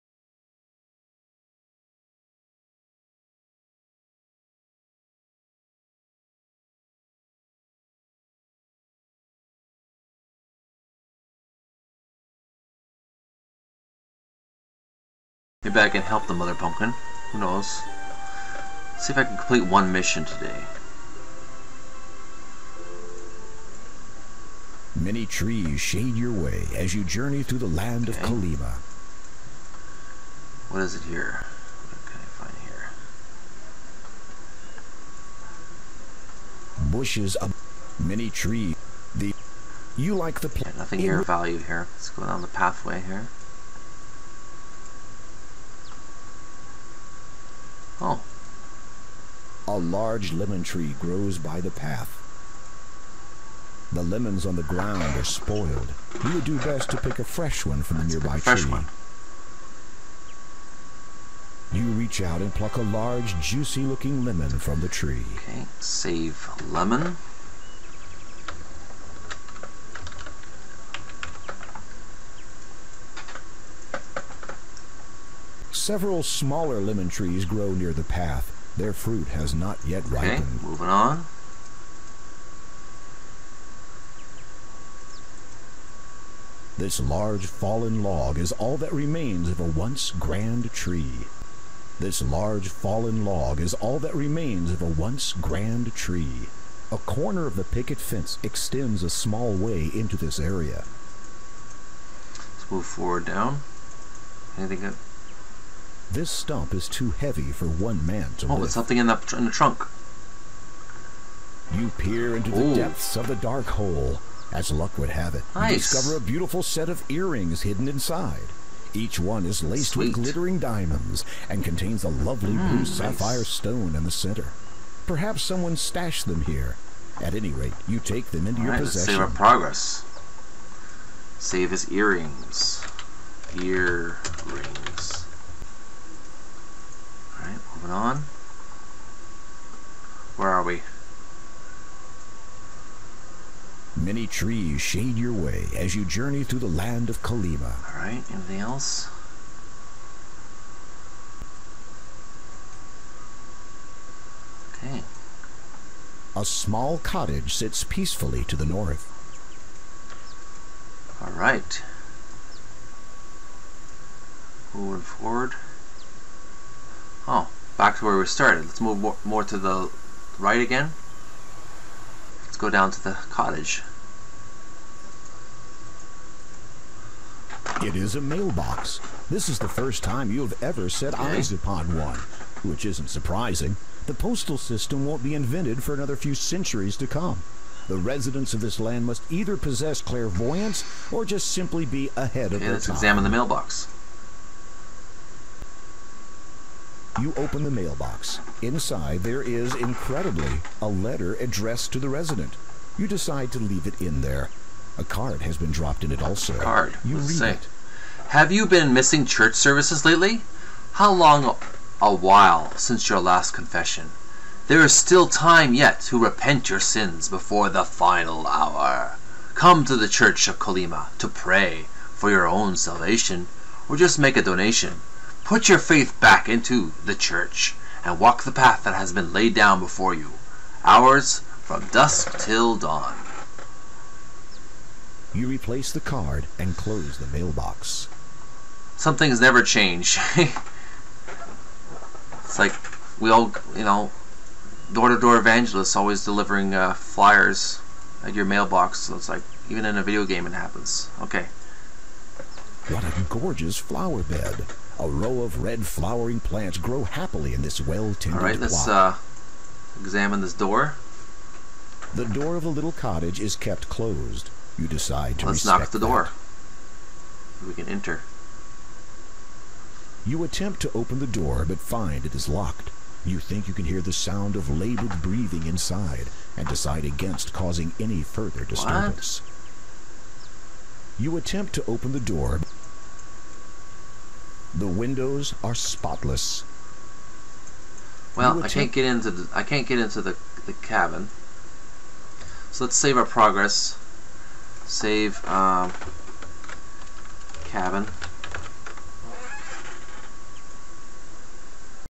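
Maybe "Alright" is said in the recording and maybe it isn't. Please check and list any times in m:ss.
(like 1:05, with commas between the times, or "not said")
2:27, 2:41.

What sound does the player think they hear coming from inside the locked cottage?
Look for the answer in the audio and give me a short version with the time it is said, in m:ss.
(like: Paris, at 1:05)
Labored breathing, at 4:34.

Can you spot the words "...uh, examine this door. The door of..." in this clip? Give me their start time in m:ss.
4:18.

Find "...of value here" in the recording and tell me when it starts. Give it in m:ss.
0:41.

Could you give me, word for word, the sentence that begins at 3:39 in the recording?
Come to the Church of Kolyma to pray for your own salvation, or just make a donation.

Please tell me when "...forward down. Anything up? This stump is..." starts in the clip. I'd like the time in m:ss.
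1:42.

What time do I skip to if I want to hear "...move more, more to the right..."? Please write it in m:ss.
2:48.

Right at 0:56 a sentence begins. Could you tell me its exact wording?
You would do best to pick a fresh one from the nearby fresh tree.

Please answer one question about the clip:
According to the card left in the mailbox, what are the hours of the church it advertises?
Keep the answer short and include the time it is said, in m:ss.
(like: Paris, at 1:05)
Dusk till dawn, at 3:51.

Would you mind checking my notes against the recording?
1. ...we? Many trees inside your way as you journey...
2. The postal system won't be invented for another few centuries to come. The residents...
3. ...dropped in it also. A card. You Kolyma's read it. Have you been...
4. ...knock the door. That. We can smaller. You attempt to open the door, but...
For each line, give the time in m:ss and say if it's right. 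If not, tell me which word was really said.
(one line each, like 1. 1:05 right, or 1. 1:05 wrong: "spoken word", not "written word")
1. 2:20 wrong: "shade", not "inside"
2. 3:04 right
3. 3:25 wrong: "Let", not "Kolyma"
4. 4:25 wrong: "enter", not "smaller".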